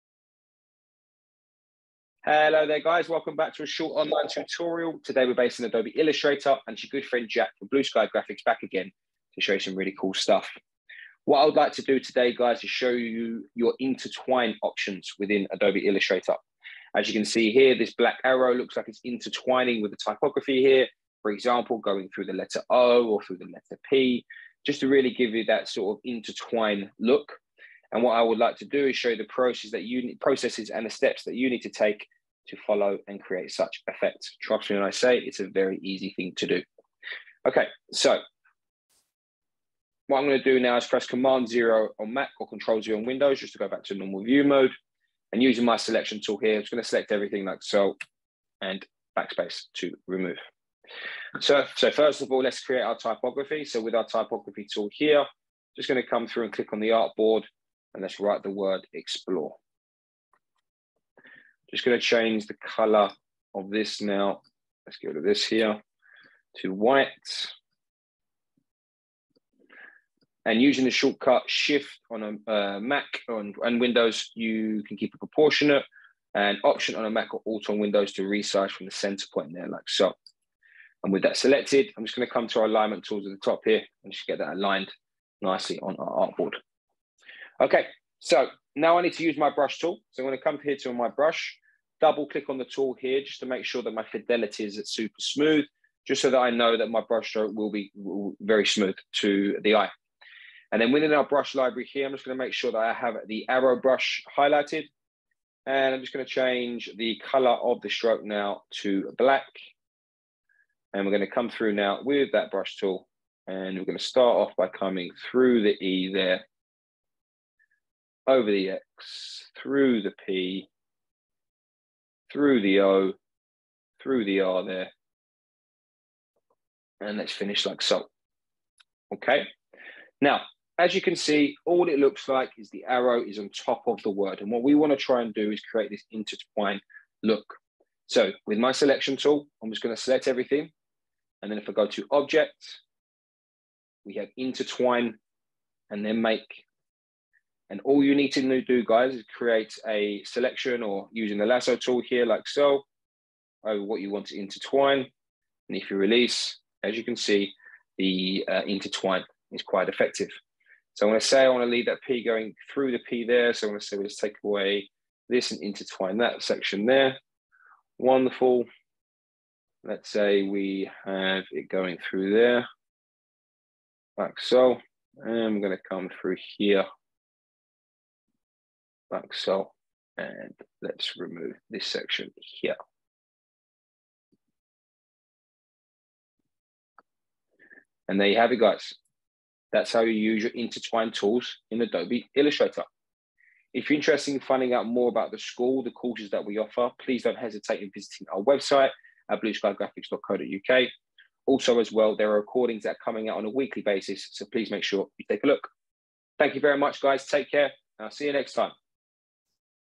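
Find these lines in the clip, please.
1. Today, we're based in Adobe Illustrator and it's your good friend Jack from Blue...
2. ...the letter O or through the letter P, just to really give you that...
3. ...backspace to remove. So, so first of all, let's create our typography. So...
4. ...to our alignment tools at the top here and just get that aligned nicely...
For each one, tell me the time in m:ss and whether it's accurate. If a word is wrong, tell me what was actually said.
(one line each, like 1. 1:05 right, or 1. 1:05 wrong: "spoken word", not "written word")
1. 0:05 right
2. 0:22 right
3. 0:49 right
4. 1:22 right.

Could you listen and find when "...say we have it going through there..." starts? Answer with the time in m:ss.
2:50.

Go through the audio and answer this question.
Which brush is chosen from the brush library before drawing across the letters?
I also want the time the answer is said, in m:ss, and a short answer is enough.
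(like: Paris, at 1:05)
arrow brush, at 1:43.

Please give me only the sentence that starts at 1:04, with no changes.
Let's get rid of this here to white.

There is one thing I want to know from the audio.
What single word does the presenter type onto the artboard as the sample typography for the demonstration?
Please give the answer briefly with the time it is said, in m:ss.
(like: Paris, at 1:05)
explore, at 0:58.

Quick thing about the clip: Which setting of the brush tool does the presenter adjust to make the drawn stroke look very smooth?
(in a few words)
fidelity.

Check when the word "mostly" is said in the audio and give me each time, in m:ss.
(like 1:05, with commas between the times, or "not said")
not said.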